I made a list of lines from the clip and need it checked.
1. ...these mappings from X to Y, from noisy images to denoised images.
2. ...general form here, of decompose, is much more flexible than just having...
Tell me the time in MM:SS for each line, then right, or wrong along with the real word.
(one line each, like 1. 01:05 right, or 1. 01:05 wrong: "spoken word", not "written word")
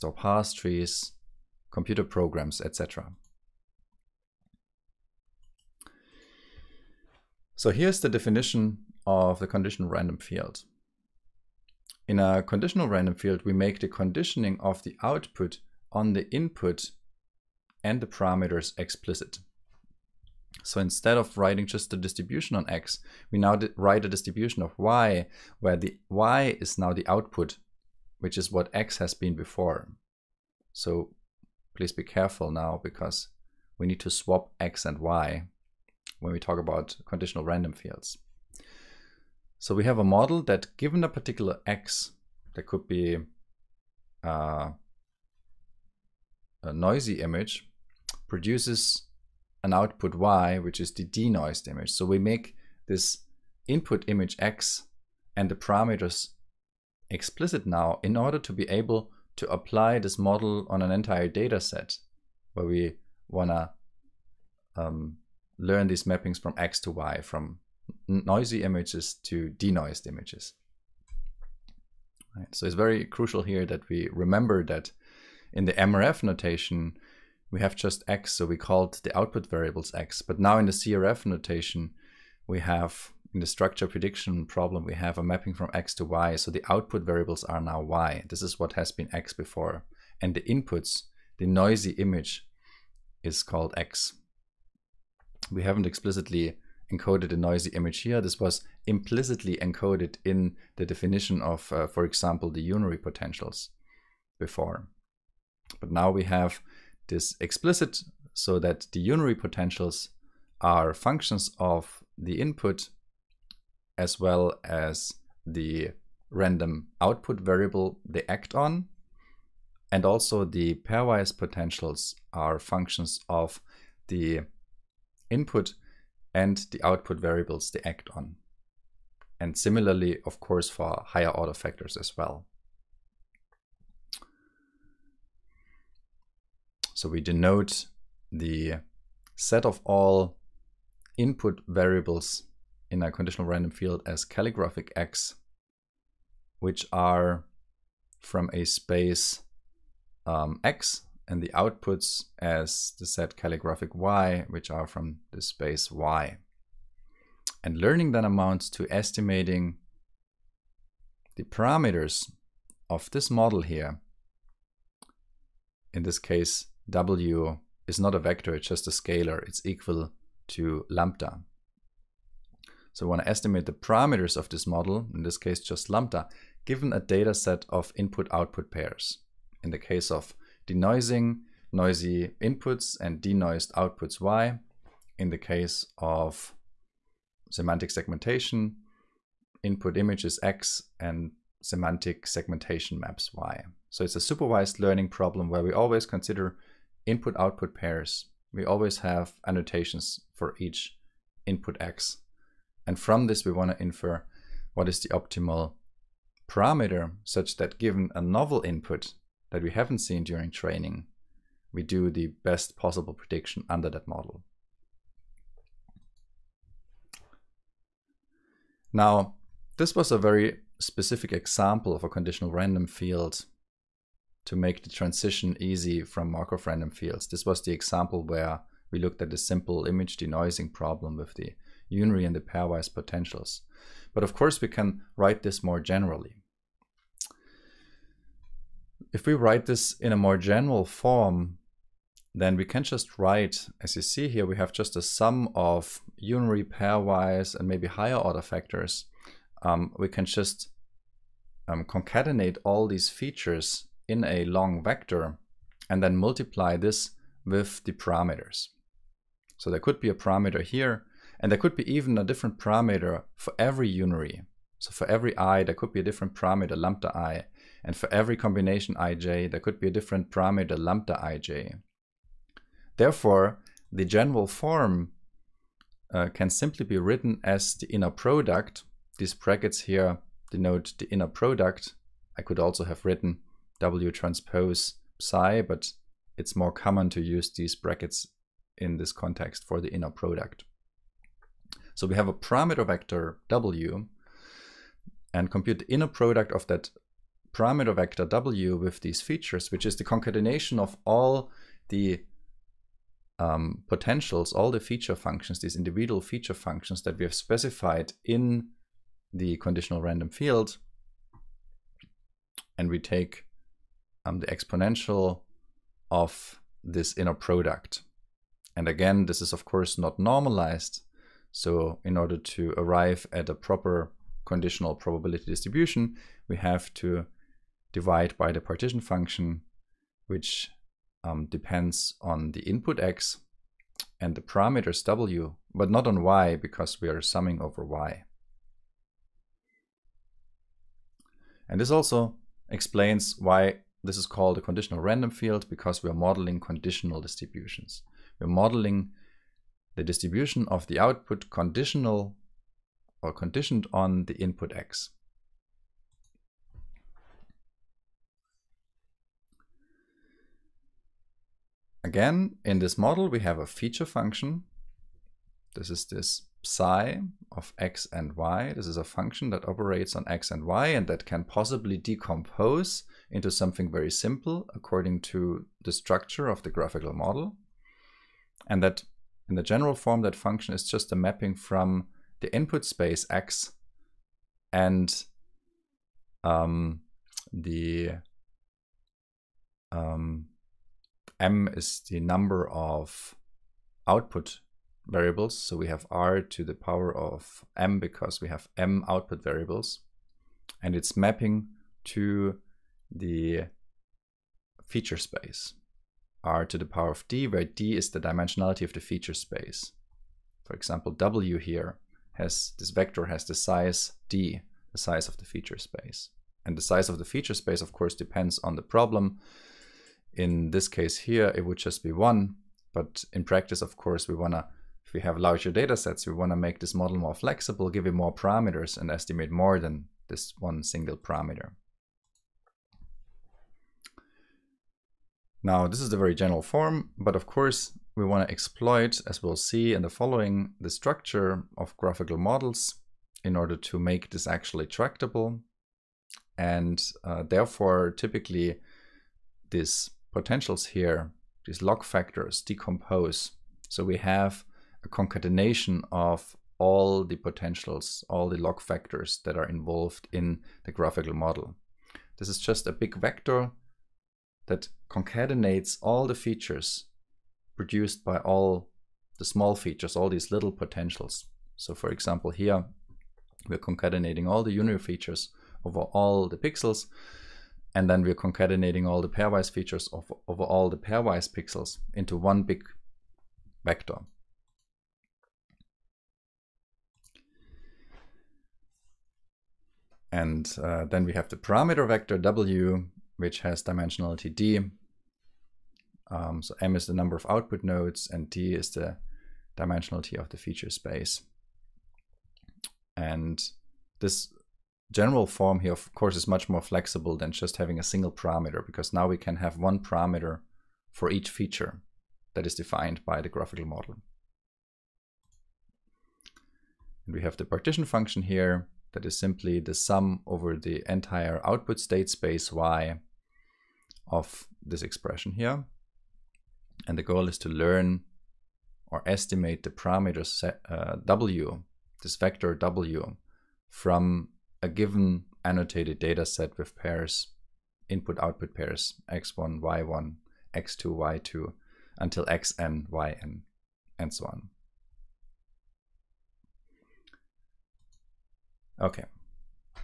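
1. 01:05 right
2. 08:25 wrong: "course", not "decompose".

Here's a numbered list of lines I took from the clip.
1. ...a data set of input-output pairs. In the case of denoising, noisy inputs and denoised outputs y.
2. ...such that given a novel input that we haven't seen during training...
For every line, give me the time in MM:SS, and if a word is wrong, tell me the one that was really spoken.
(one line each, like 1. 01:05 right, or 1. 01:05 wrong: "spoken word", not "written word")
1. 02:56 right
2. 03:27 right.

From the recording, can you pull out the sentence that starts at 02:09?
And similarly, of course, for higher order factors as well.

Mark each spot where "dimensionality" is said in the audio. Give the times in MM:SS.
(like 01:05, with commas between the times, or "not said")
06:48, 08:13, 08:19.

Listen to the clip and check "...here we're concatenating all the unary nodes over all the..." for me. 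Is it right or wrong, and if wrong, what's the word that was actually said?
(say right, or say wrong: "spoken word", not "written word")
wrong: "features", not "nodes".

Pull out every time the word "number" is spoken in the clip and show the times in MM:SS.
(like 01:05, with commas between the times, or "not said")
06:32, 08:17.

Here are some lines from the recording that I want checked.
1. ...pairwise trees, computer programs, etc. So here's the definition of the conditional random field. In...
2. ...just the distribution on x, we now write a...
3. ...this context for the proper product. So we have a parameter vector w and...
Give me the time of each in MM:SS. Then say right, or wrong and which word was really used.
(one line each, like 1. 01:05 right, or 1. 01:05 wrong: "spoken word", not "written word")
1. 00:00 wrong: "parse", not "pairwise"
2. 00:21 right
3. 04:48 wrong: "inner", not "proper".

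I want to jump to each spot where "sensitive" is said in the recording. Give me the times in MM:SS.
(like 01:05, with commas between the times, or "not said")
not said.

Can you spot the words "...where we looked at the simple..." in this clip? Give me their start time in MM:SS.
03:48.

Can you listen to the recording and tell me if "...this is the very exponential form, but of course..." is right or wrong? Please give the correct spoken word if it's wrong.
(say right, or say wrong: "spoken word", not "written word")
wrong: "general", not "exponential".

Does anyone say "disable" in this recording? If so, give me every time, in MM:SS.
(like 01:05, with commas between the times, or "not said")
not said.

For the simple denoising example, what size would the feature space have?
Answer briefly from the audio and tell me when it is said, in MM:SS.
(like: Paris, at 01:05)
1, at 07:01.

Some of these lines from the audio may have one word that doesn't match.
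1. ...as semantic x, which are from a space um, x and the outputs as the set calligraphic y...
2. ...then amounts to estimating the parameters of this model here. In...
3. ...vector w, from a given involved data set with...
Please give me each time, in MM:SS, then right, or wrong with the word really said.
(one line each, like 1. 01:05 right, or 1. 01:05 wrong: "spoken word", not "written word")
1. 02:24 wrong: "calligraphic", not "semantic"
2. 02:38 right
3. 08:52 wrong: "annotated", not "involved".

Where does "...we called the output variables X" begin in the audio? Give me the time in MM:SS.
01:18.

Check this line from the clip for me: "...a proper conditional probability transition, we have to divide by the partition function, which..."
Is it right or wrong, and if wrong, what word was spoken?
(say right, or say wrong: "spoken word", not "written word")
wrong: "distribution", not "transition".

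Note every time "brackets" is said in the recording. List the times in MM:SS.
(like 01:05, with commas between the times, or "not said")
04:39, 04:47.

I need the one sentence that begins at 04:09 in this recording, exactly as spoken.
Um, we can just um, concatenate all these features in a long vector and then multiply this with the parameters.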